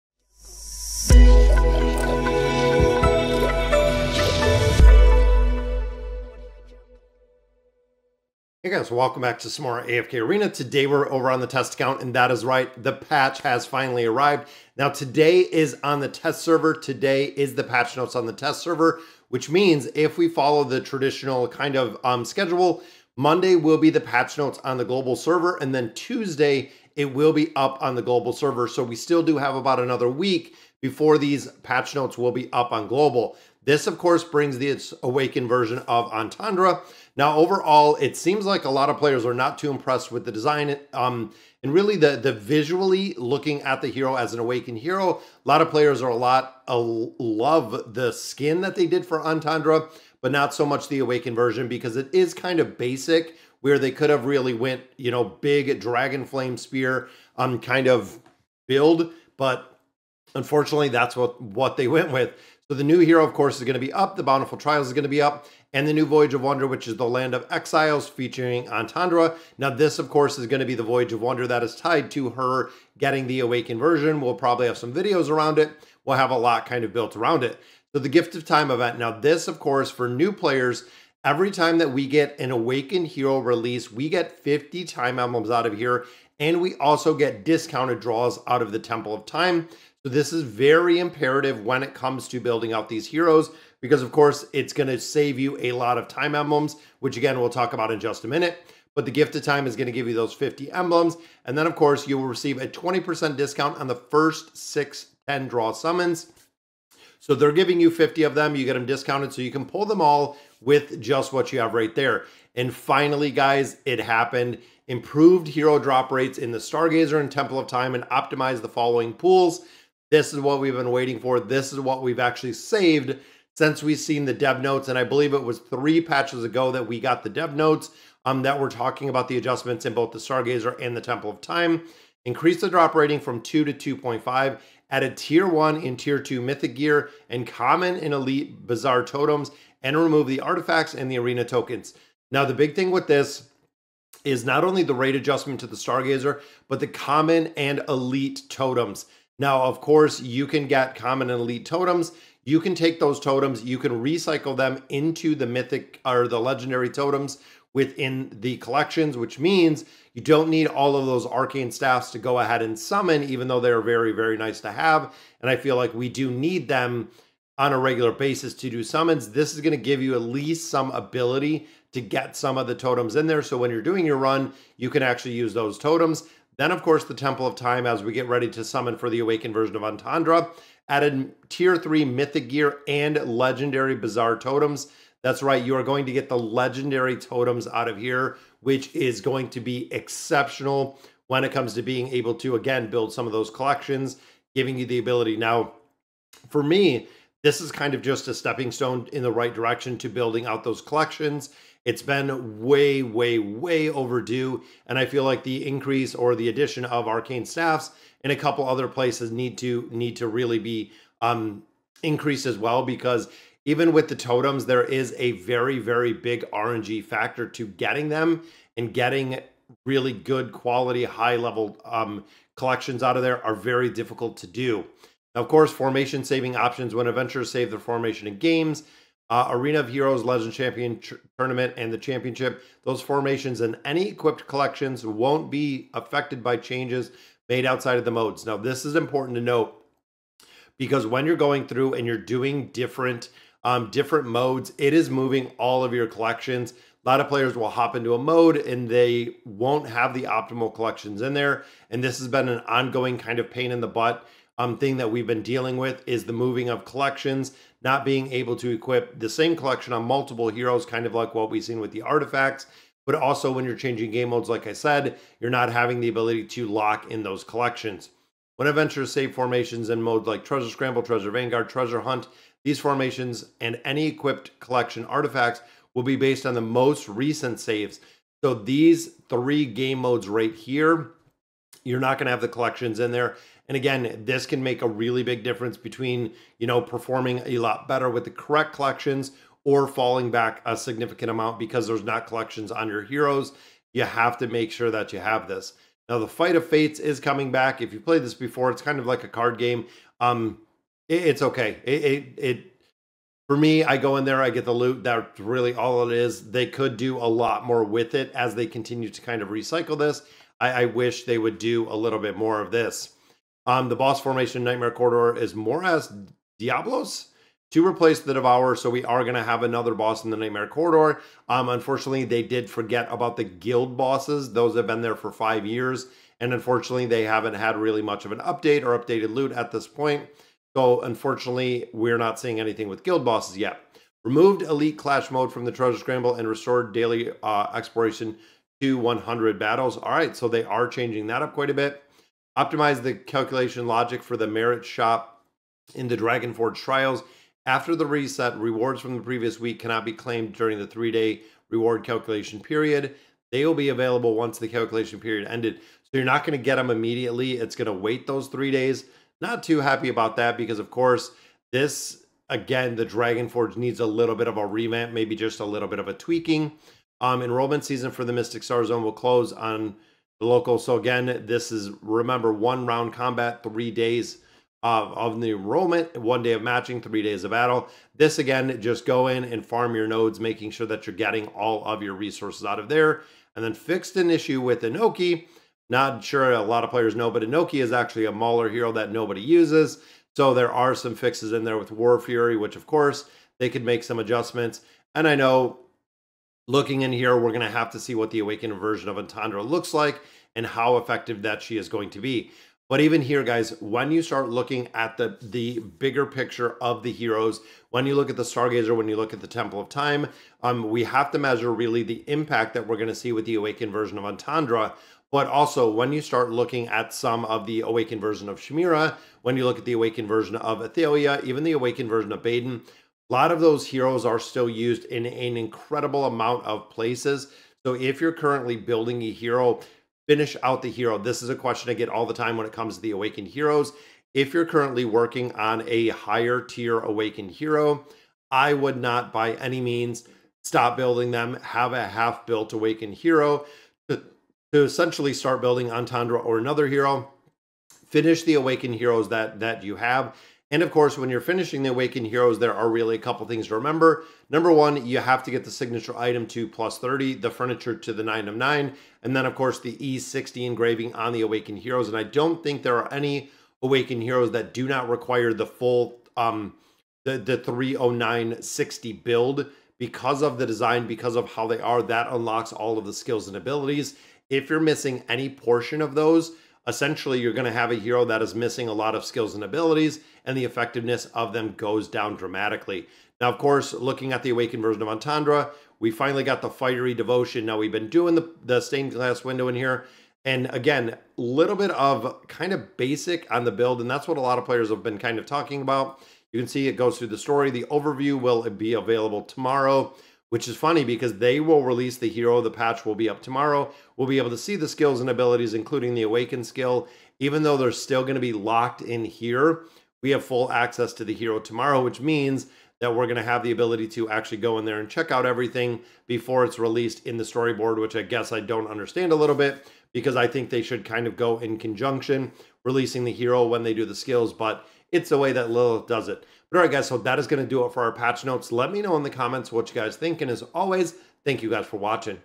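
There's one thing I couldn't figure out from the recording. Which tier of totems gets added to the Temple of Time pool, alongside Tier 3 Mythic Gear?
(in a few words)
Legendary Bizarre Totems.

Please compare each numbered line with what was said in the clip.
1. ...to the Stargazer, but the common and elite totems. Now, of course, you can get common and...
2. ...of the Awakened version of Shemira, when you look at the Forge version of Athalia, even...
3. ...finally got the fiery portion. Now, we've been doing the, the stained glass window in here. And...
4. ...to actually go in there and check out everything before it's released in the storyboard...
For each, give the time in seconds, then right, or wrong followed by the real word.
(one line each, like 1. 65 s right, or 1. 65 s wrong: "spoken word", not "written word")
1. 145 s right
2. 417 s wrong: "Awakened", not "Forge"
3. 486 s wrong: "devotion", not "portion"
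4. 514 s right.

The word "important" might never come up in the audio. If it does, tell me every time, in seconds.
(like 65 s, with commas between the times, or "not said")
238 s.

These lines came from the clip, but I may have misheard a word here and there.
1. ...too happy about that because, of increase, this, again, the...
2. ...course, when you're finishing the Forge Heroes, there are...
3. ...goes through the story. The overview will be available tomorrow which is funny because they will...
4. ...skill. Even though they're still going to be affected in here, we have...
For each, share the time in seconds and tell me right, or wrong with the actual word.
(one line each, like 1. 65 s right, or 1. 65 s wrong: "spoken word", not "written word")
1. 359 s wrong: "course", not "increase"
2. 450 s wrong: "Awakened", not "Forge"
3. 496 s right
4. 506 s wrong: "locked", not "affected".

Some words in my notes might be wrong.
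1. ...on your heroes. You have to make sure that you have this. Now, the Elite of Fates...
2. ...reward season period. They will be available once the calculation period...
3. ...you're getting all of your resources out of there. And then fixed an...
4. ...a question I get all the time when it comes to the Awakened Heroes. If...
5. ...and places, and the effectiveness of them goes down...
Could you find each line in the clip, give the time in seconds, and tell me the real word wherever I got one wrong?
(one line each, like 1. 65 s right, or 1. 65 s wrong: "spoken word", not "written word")
1. 292 s wrong: "Fight", not "Elite"
2. 351 s wrong: "calculation", not "season"
3. 381 s right
4. 431 s right
5. 479 s wrong: "abilities", not "places".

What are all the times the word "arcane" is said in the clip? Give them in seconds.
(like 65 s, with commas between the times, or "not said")
161 s, 207 s.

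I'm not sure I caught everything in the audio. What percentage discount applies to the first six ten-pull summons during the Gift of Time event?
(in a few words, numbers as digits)
20%.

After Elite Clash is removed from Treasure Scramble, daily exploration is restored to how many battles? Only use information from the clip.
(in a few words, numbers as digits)
100 battles.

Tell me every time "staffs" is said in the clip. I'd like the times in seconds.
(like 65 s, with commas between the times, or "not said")
161 s, 207 s.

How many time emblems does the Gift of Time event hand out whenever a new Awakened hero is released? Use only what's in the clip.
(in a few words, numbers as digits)
50.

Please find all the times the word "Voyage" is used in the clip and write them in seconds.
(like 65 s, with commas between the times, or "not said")
66 s, 70 s.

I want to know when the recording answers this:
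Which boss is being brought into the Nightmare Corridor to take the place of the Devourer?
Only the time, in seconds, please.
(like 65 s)
316 s.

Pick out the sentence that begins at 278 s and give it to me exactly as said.
So these three game modes right here you're not going to have the collections in there.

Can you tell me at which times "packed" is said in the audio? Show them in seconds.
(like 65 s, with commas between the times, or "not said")
not said.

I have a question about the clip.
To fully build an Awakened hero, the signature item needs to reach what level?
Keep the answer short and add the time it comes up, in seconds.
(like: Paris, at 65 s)
+30, at 456 s.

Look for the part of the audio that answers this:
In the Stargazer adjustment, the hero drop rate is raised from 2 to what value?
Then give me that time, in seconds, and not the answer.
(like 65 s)
133 s.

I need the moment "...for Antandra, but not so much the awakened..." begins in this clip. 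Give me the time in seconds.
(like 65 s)
49 s.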